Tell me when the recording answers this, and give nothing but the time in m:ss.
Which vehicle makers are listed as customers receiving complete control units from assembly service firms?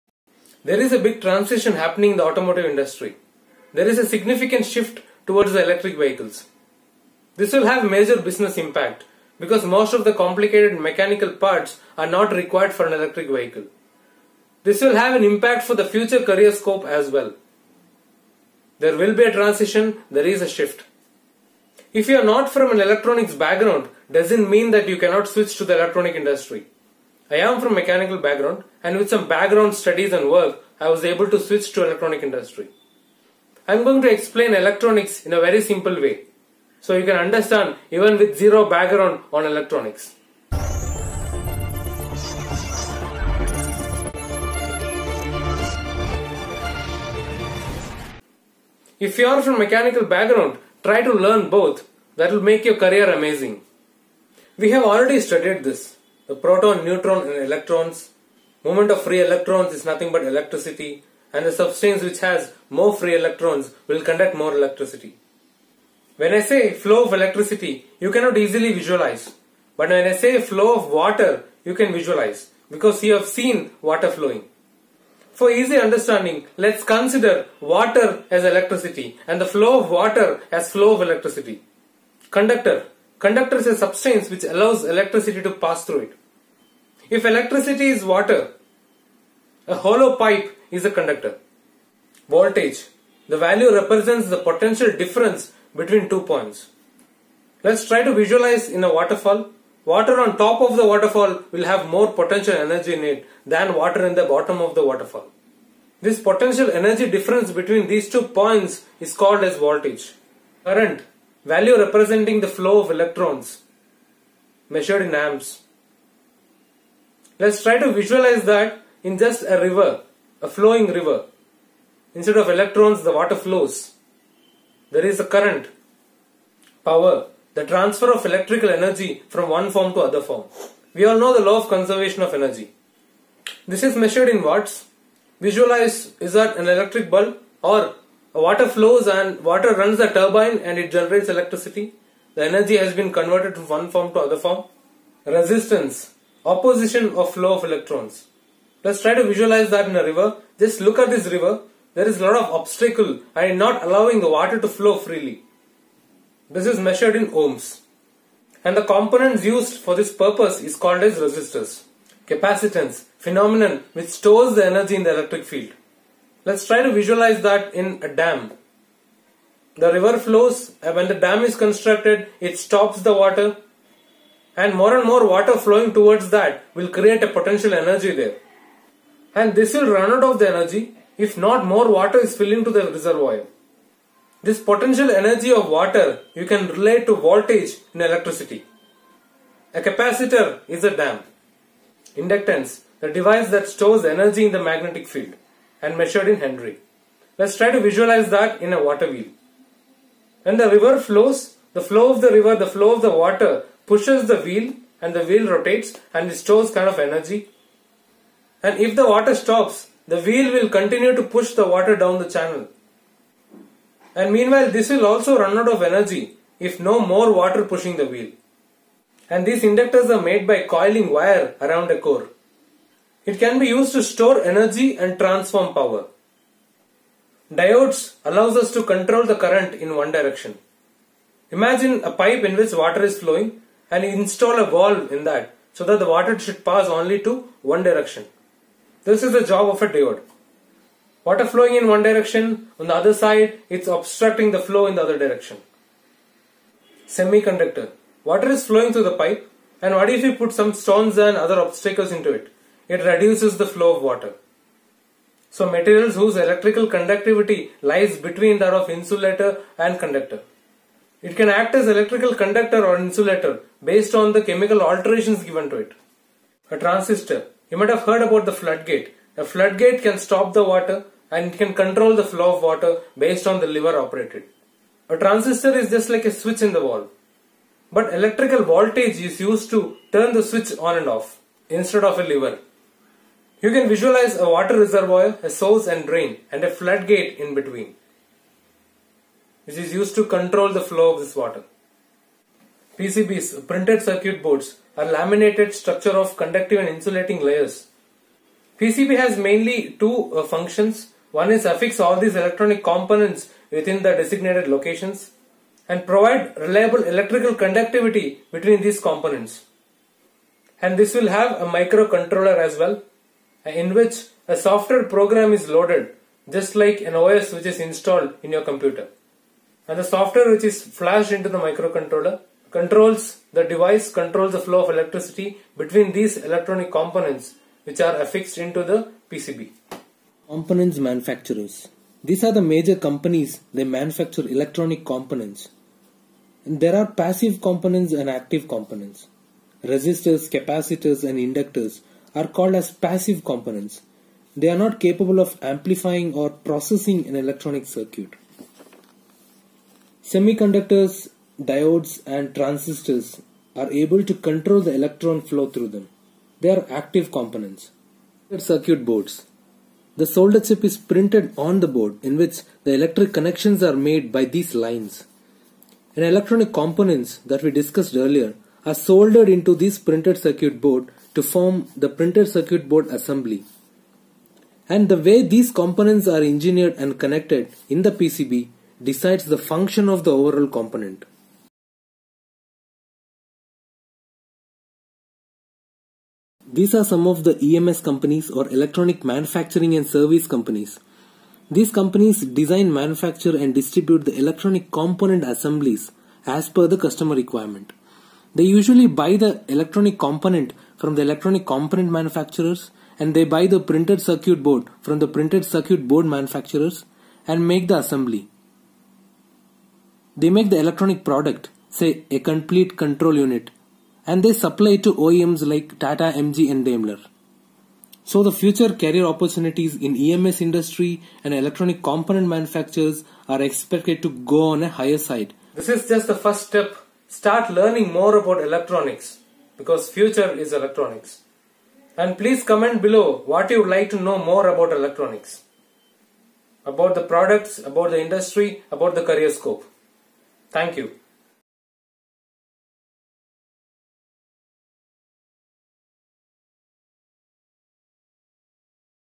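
6:55.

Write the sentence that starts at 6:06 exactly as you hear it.
And electronic components that we discussed earlier are soldered into this printed circuit board to form the printed circuit board assembly.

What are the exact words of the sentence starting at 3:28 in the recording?
And if the water stops, the wheel will continue to push the water down the channel.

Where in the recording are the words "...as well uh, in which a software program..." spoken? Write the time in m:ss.
5:12.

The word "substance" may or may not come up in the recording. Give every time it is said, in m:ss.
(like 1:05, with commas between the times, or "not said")
1:01, 1:23.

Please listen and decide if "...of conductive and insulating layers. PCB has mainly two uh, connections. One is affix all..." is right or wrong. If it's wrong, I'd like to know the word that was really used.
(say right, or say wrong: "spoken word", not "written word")
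wrong: "functions", not "connections".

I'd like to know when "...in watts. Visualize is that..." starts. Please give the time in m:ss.
2:14.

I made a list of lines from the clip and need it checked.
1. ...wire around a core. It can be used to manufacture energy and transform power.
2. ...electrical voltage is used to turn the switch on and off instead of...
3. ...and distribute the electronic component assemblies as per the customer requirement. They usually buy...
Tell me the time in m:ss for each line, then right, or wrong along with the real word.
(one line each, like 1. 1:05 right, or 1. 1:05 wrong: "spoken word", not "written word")
1. 3:41 wrong: "store", not "manufacture"
2. 4:38 right
3. 6:33 right.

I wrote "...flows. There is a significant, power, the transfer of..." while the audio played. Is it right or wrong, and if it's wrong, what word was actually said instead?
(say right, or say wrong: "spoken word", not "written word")
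wrong: "current", not "significant".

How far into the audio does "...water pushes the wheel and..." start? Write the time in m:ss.
3:23.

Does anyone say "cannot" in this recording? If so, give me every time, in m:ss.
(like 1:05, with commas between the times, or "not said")
0:24, 1:08.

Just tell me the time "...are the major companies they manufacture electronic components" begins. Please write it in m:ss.
5:32.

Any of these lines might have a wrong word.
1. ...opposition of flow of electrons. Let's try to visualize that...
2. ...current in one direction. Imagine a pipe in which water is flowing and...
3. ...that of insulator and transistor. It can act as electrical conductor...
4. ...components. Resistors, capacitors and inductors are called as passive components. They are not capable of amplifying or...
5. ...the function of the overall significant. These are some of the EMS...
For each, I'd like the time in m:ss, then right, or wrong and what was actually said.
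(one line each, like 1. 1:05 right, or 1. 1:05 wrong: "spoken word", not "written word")
1. 2:26 right
2. 3:49 right
3. 4:18 wrong: "conductor", not "transistor"
4. 5:38 right
5. 6:19 wrong: "component", not "significant".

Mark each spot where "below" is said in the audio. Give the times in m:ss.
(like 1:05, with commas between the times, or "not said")
7:13.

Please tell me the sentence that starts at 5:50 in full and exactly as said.
Semiconductors, diodes and transistors are able to control the electron flow through them.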